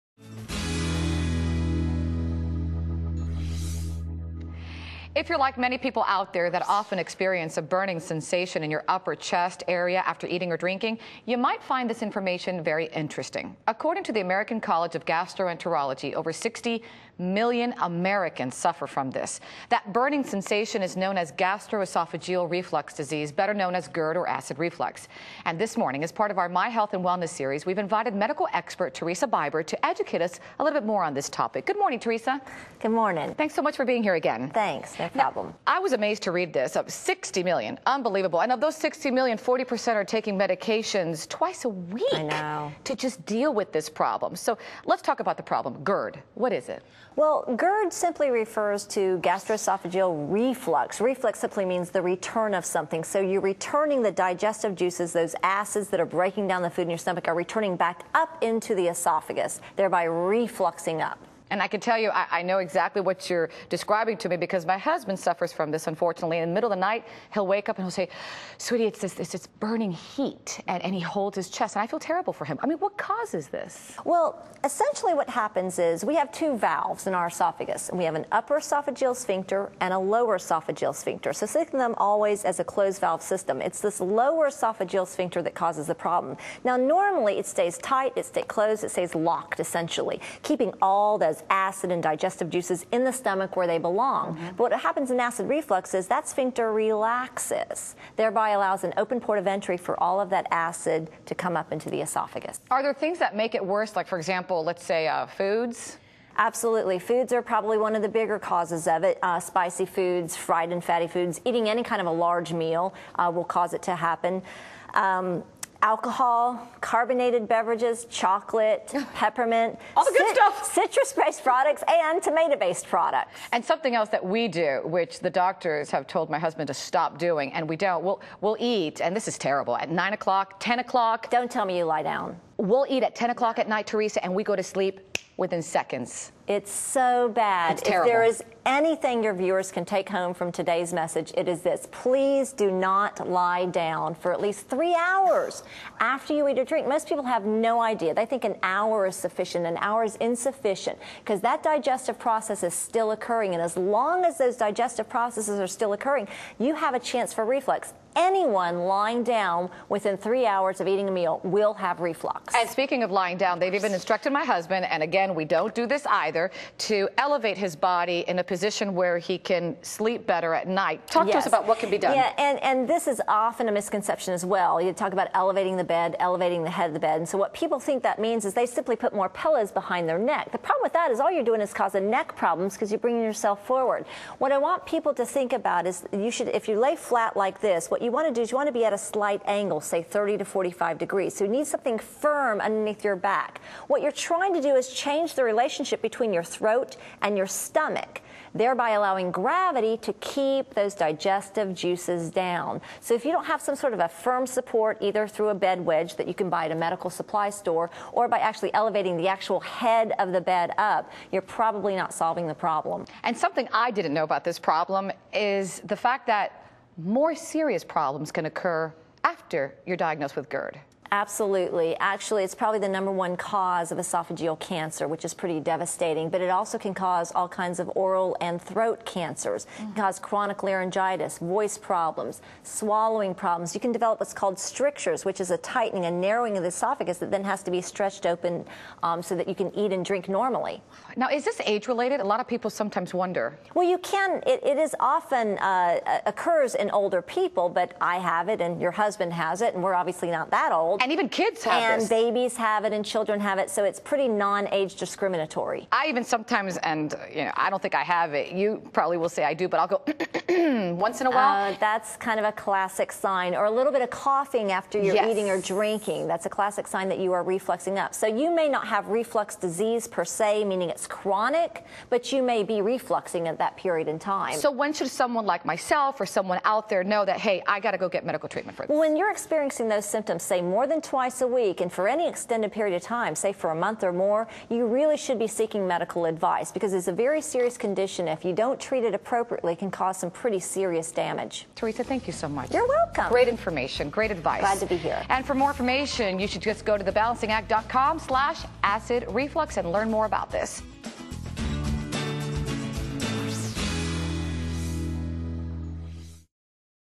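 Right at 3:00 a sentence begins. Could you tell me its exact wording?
The problem with that is all you're doing is causing neck problems because you're bringing yourself forward.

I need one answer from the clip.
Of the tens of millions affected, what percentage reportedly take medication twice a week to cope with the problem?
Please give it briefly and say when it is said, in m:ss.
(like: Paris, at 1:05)
40%, at 0:39.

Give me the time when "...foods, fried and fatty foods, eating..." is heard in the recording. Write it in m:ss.
1:49.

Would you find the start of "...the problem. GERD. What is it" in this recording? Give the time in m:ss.
0:45.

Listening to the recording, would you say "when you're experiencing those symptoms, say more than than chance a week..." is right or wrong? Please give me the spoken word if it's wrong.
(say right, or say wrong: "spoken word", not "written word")
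wrong: "twice", not "chance".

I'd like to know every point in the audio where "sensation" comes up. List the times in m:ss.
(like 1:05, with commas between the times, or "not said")
0:07, 0:20.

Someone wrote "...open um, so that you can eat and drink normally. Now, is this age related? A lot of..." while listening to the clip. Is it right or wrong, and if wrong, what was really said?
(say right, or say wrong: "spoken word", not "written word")
right.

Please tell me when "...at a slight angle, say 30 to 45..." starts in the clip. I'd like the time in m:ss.
3:08.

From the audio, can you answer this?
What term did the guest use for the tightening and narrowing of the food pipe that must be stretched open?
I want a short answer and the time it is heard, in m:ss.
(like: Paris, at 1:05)
strictures, at 3:54.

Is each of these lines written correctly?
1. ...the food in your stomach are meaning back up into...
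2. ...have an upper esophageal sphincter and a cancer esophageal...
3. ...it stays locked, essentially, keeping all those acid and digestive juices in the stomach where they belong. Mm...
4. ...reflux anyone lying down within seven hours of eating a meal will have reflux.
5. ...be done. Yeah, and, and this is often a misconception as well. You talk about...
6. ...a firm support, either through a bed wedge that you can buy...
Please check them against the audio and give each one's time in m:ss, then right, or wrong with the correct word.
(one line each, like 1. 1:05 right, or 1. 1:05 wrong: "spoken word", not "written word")
1. 0:56 wrong: "returning", not "meaning"
2. 1:18 wrong: "lower", not "cancer"
3. 1:28 right
4. 2:37 wrong: "three", not "seven"
5. 2:51 right
6. 3:23 right.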